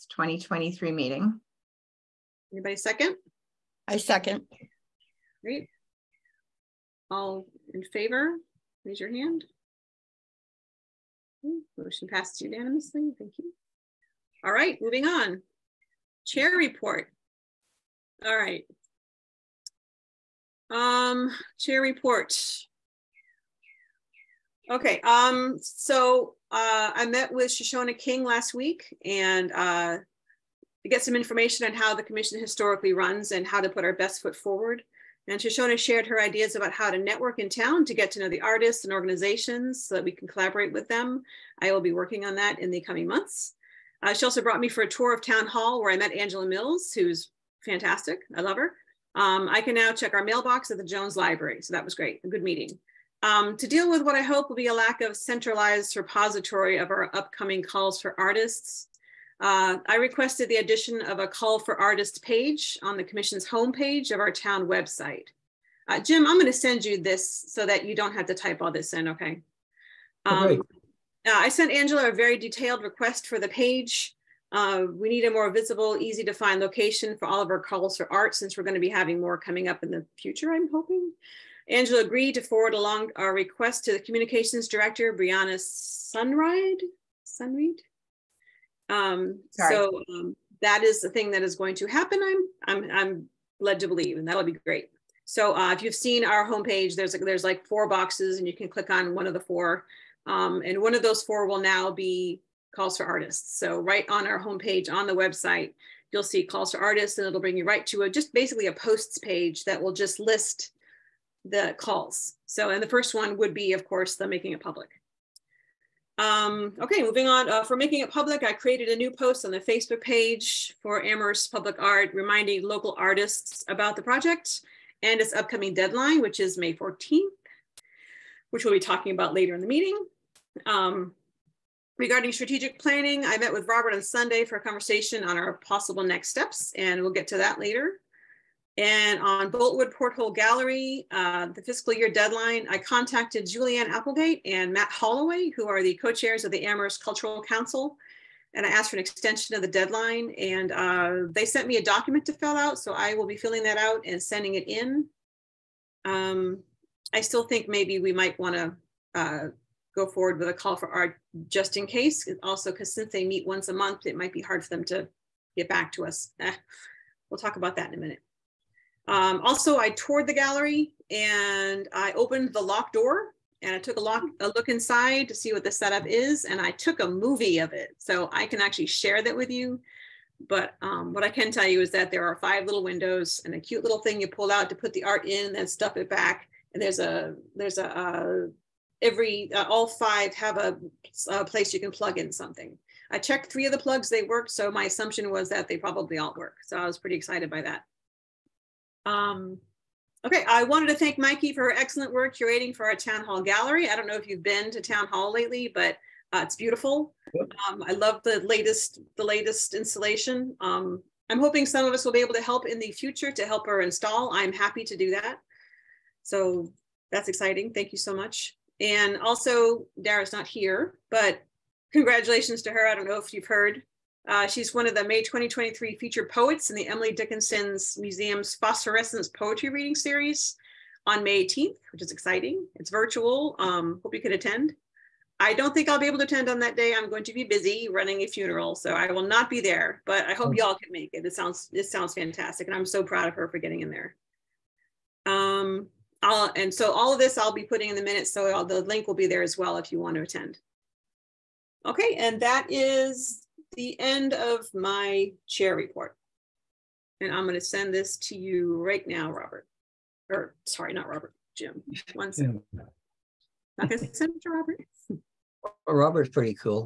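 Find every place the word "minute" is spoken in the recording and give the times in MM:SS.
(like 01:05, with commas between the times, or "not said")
02:48, 04:08.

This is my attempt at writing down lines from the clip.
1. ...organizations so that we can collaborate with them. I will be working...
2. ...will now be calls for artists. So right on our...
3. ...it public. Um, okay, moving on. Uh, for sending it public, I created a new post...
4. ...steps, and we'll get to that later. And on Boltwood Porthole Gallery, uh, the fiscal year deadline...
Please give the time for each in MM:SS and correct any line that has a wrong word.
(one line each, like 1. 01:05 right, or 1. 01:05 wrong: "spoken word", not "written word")
1. 00:38 right
2. 01:41 right
3. 01:54 wrong: "making", not "sending"
4. 02:16 right.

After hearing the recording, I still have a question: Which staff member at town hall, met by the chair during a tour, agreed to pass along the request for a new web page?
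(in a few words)
Angela Mills.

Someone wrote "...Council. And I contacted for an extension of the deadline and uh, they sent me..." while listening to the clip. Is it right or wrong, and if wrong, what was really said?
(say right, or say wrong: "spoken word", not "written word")
wrong: "asked", not "contacted".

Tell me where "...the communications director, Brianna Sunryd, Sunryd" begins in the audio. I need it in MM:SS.
01:23.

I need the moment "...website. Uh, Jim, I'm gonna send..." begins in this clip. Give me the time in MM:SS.
01:04.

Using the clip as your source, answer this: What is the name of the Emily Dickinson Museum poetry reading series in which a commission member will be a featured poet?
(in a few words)
Phosphorescence.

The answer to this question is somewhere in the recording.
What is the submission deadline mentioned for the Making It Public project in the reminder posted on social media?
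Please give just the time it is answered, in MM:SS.
02:06.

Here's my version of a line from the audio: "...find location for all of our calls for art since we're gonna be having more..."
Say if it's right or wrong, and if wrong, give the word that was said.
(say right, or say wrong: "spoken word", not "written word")
right.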